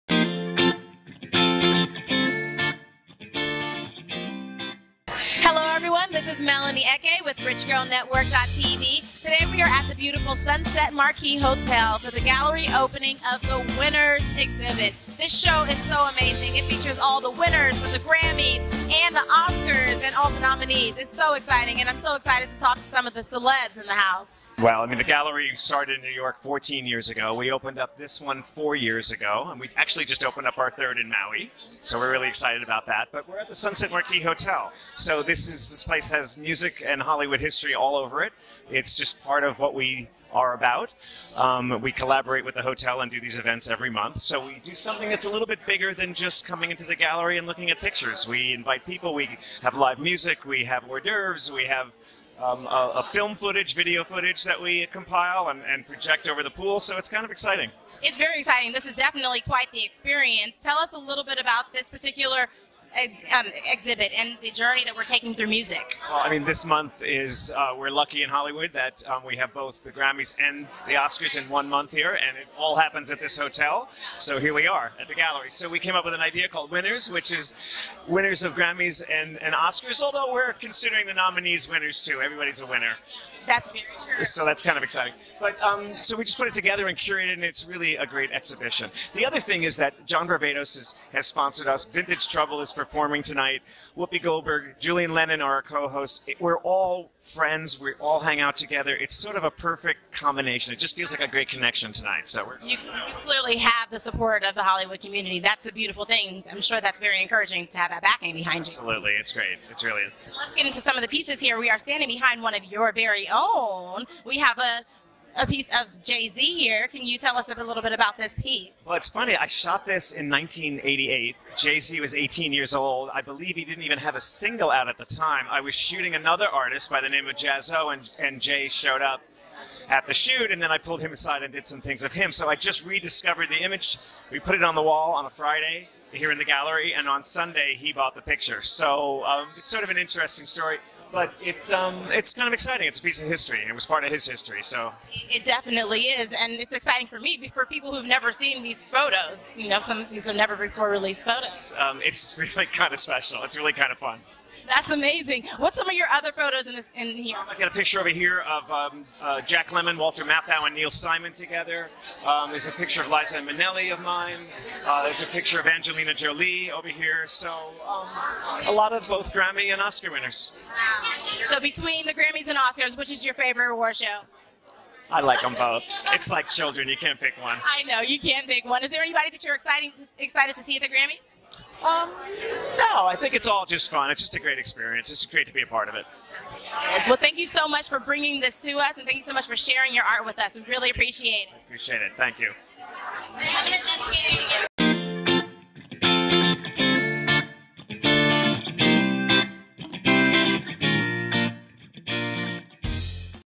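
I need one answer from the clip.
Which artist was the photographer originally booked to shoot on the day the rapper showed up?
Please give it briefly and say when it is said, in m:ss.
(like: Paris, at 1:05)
Jaz-O, at 2:07.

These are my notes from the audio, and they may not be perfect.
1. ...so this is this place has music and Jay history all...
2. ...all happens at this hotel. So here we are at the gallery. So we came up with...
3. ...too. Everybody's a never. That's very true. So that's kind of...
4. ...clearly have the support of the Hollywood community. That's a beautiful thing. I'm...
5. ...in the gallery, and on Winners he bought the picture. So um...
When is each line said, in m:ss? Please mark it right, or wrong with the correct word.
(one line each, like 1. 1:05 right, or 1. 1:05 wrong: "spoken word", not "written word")
1. 0:34 wrong: "Hollywood", not "Jay"
2. 1:12 right
3. 1:22 wrong: "winner", not "never"
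4. 1:43 right
5. 2:16 wrong: "Sunday", not "Winners".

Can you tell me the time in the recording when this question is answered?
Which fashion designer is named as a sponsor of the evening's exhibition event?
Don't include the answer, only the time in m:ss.
1:30.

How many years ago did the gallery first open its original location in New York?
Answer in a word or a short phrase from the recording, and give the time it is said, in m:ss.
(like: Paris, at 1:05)
14, at 0:26.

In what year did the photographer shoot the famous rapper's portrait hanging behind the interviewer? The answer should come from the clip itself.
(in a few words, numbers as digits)
1988.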